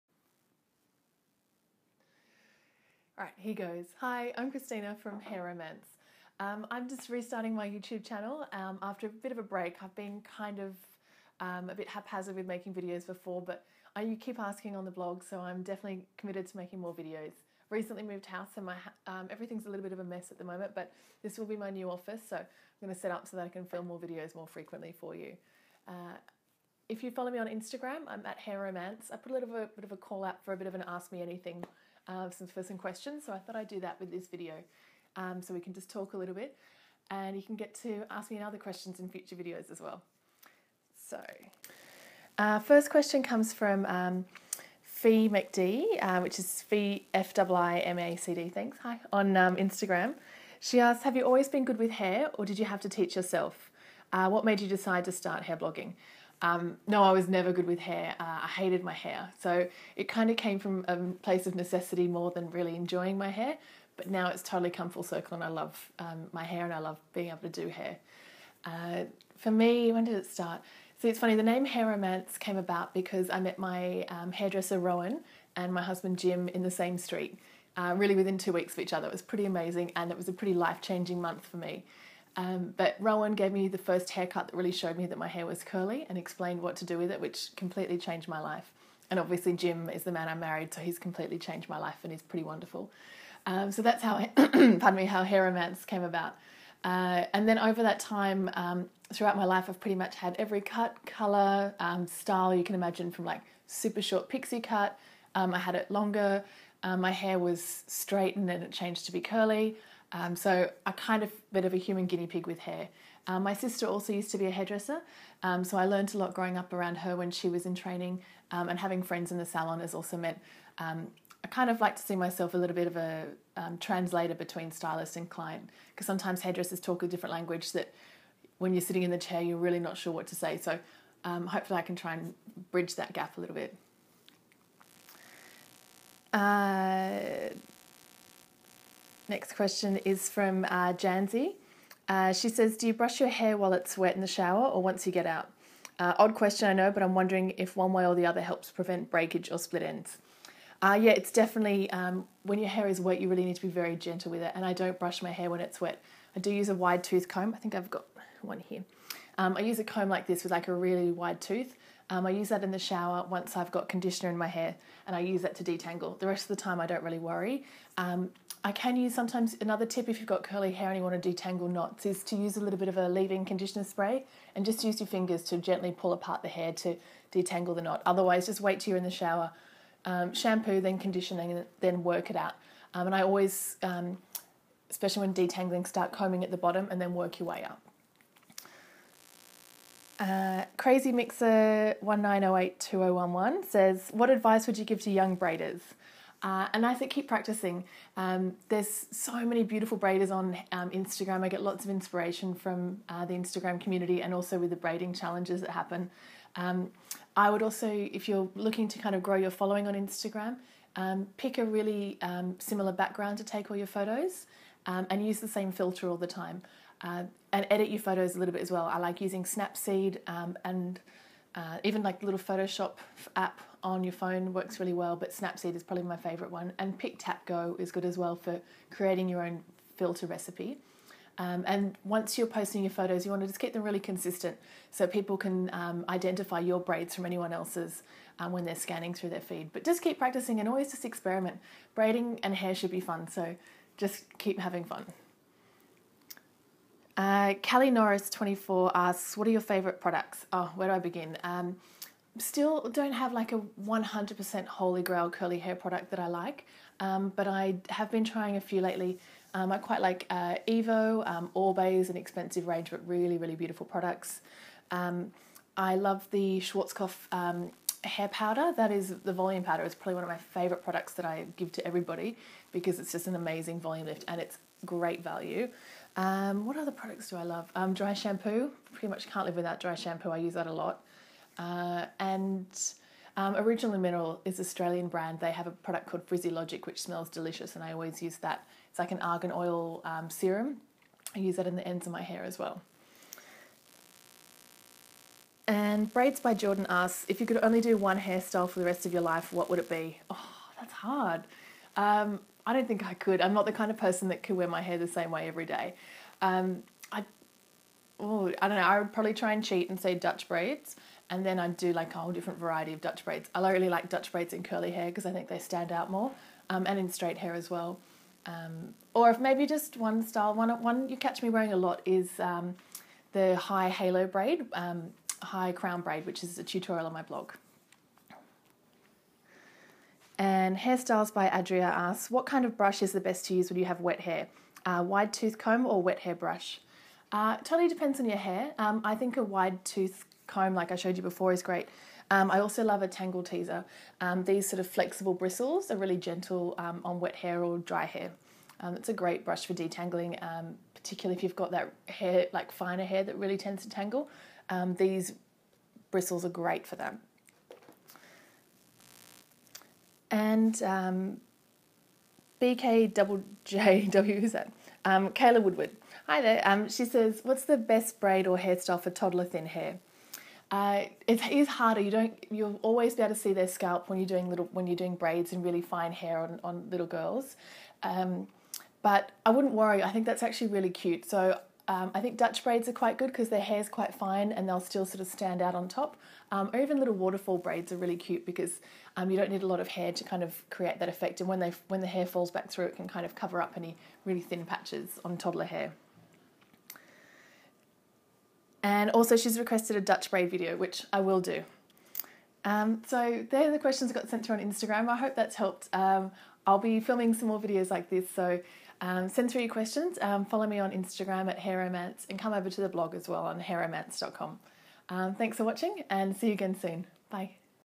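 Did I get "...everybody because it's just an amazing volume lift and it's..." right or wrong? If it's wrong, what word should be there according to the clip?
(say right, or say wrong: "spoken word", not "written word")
right.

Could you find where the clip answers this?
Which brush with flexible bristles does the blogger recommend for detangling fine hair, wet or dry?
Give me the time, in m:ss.
5:43.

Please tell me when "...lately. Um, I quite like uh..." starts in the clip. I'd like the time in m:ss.
4:18.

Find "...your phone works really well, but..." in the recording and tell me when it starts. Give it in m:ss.
3:44.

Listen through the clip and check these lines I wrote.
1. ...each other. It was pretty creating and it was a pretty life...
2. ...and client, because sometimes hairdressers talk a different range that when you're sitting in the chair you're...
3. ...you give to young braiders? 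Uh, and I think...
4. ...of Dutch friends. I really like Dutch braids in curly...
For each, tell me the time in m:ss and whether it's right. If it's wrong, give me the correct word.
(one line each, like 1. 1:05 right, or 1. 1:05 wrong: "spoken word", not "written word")
1. 1:18 wrong: "amazing", not "creating"
2. 2:05 wrong: "language", not "range"
3. 3:14 right
4. 5:12 wrong: "braids", not "friends".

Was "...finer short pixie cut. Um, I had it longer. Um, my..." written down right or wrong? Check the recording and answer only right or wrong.
wrong.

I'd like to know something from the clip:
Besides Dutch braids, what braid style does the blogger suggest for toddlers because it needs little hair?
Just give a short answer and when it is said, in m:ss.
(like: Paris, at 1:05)
Waterfall braids, at 6:26.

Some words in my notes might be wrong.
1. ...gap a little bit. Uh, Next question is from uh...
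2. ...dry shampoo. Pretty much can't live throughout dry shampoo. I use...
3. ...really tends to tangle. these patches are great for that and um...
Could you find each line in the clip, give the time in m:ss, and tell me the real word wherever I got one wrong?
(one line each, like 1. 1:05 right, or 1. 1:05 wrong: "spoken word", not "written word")
1. 2:13 right
2. 4:37 wrong: "without", not "throughout"
3. 5:53 wrong: "bristles", not "patches".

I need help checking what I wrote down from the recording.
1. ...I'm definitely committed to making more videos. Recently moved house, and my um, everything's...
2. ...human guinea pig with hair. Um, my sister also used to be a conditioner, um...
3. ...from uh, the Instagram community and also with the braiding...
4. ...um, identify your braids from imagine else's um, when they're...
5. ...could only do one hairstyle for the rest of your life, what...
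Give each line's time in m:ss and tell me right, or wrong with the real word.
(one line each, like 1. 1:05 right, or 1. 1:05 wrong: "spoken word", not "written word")
1. 0:15 right
2. 1:51 wrong: "hairdresser", not "conditioner"
3. 3:22 right
4. 3:55 wrong: "anyone", not "imagine"
5. 4:57 right.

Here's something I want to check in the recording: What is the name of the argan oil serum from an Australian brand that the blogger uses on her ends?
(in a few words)
Frizzy Logic.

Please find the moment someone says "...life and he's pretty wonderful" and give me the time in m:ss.
1:31.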